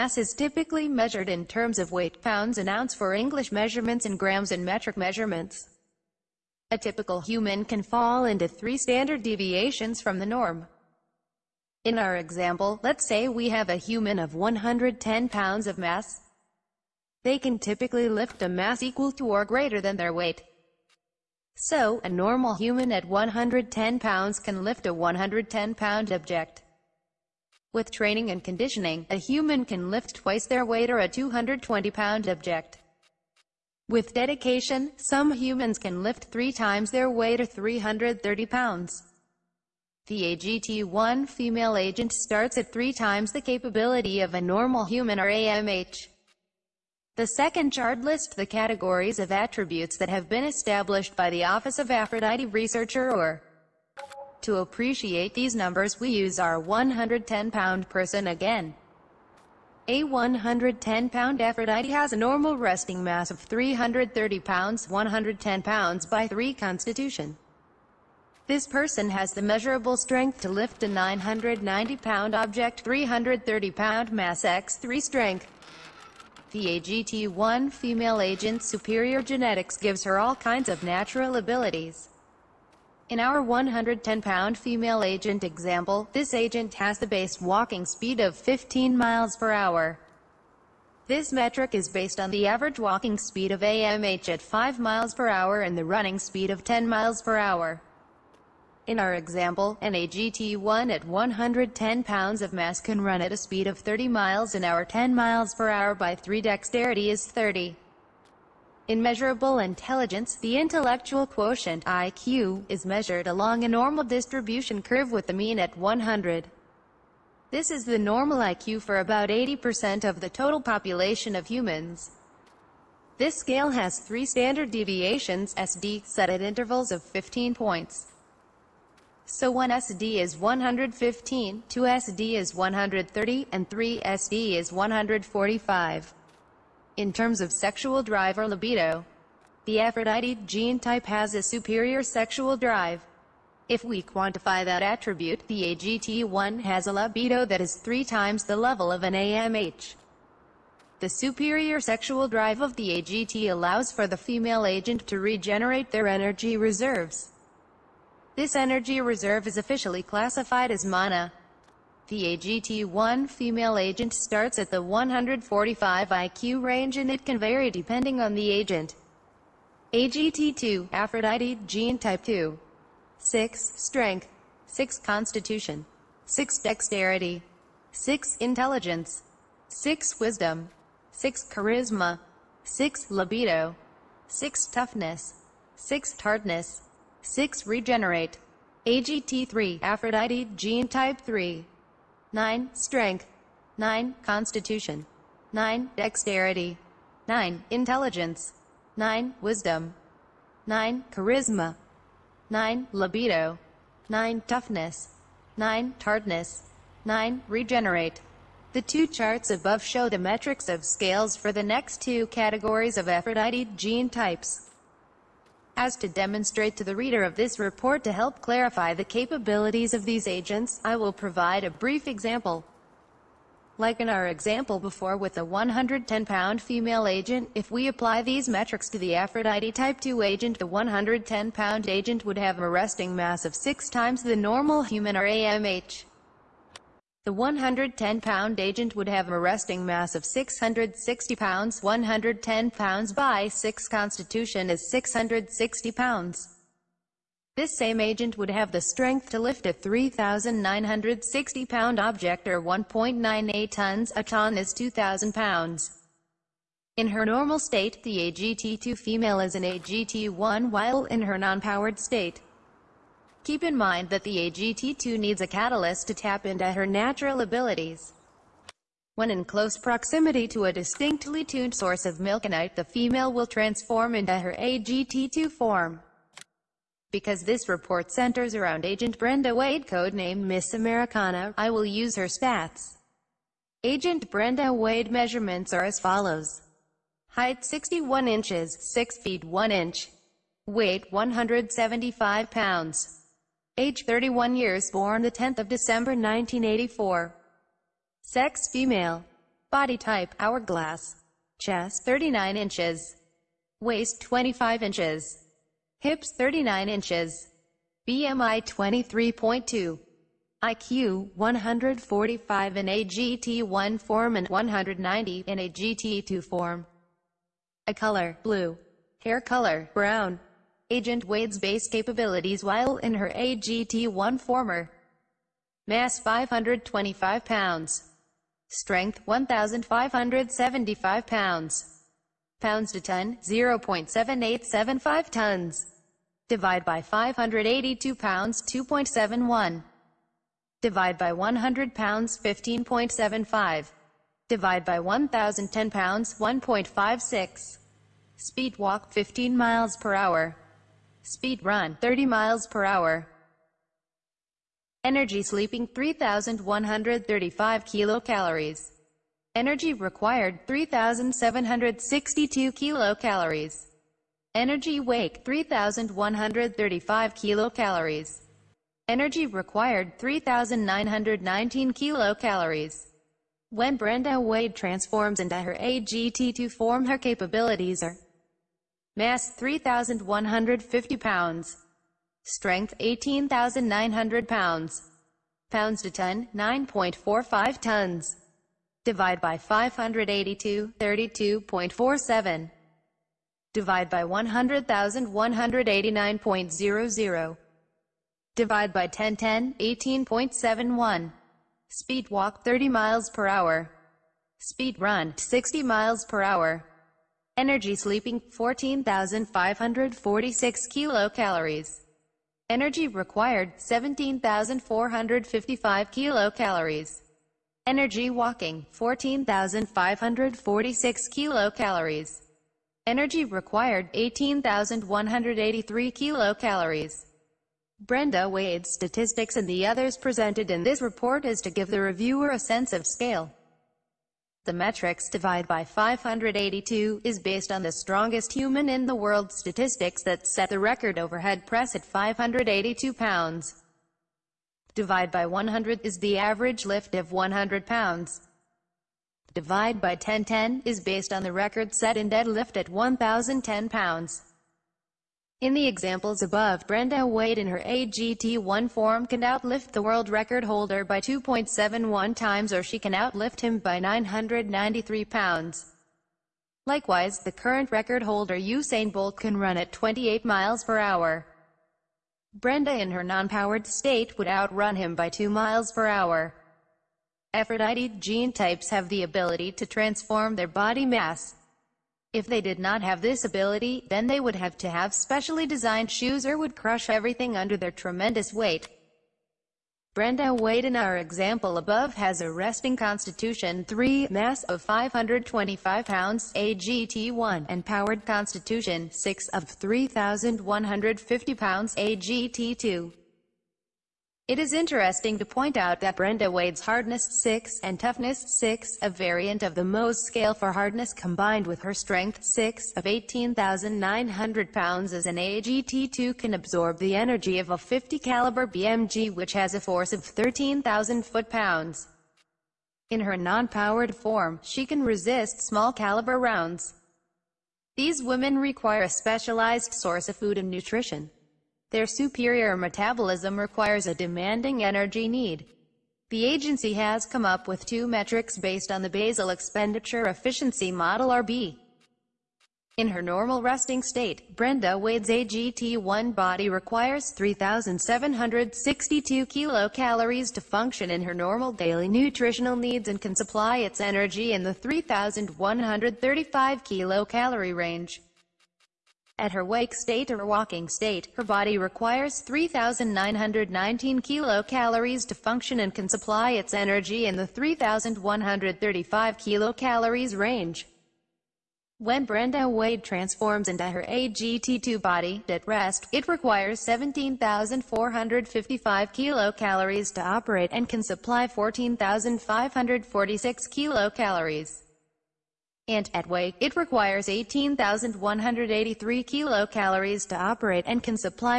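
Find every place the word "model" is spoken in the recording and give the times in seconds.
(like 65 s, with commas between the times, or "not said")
540 s.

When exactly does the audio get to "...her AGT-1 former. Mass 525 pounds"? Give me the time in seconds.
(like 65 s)
323 s.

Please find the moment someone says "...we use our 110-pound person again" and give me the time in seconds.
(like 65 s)
55 s.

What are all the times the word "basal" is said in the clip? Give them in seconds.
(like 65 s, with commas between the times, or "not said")
539 s.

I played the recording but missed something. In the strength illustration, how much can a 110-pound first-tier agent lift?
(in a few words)
990 pounds.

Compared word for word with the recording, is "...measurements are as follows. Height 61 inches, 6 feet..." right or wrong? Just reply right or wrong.
right.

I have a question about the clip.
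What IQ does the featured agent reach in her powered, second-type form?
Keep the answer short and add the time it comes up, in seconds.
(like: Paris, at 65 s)
190, at 314 s.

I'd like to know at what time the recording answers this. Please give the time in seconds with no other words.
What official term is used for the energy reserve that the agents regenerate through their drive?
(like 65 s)
160 s.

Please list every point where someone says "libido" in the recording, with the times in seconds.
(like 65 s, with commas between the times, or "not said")
138 s, 146 s, 183 s, 202 s.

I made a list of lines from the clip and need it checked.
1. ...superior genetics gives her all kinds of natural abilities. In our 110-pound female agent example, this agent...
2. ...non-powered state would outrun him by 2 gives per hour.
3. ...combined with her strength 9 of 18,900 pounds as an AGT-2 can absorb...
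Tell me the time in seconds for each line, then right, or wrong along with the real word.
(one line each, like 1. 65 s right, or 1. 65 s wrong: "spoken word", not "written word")
1. 78 s right
2. 473 s wrong: "miles", not "gives"
3. 511 s wrong: "6", not "9".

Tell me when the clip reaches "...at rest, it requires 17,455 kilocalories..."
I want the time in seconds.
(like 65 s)
575 s.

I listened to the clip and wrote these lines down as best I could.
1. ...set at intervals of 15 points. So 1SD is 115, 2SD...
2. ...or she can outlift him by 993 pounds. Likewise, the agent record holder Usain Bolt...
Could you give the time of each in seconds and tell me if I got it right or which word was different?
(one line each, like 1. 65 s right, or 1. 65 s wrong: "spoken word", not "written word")
1. 126 s right
2. 462 s wrong: "current", not "agent".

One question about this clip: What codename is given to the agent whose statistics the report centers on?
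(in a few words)
Miss Americana.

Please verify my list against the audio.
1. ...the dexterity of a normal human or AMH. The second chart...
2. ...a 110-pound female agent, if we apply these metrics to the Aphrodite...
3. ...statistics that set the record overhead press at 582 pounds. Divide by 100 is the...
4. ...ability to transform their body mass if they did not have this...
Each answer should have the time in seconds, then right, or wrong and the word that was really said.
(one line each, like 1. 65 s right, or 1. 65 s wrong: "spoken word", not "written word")
1. 43 s wrong: "capability", not "dexterity"
2. 225 s right
3. 439 s right
4. 479 s right.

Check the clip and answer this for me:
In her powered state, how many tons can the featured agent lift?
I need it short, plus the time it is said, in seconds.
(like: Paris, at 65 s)
9.45 tons, at 386 s.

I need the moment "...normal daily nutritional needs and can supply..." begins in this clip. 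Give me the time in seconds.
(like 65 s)
551 s.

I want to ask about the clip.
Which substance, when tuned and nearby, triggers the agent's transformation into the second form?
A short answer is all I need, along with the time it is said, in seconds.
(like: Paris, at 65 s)
milkanite, at 272 s.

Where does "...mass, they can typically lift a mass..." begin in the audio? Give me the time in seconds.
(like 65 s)
15 s.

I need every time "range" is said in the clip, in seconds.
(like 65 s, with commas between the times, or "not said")
166 s, 557 s, 570 s.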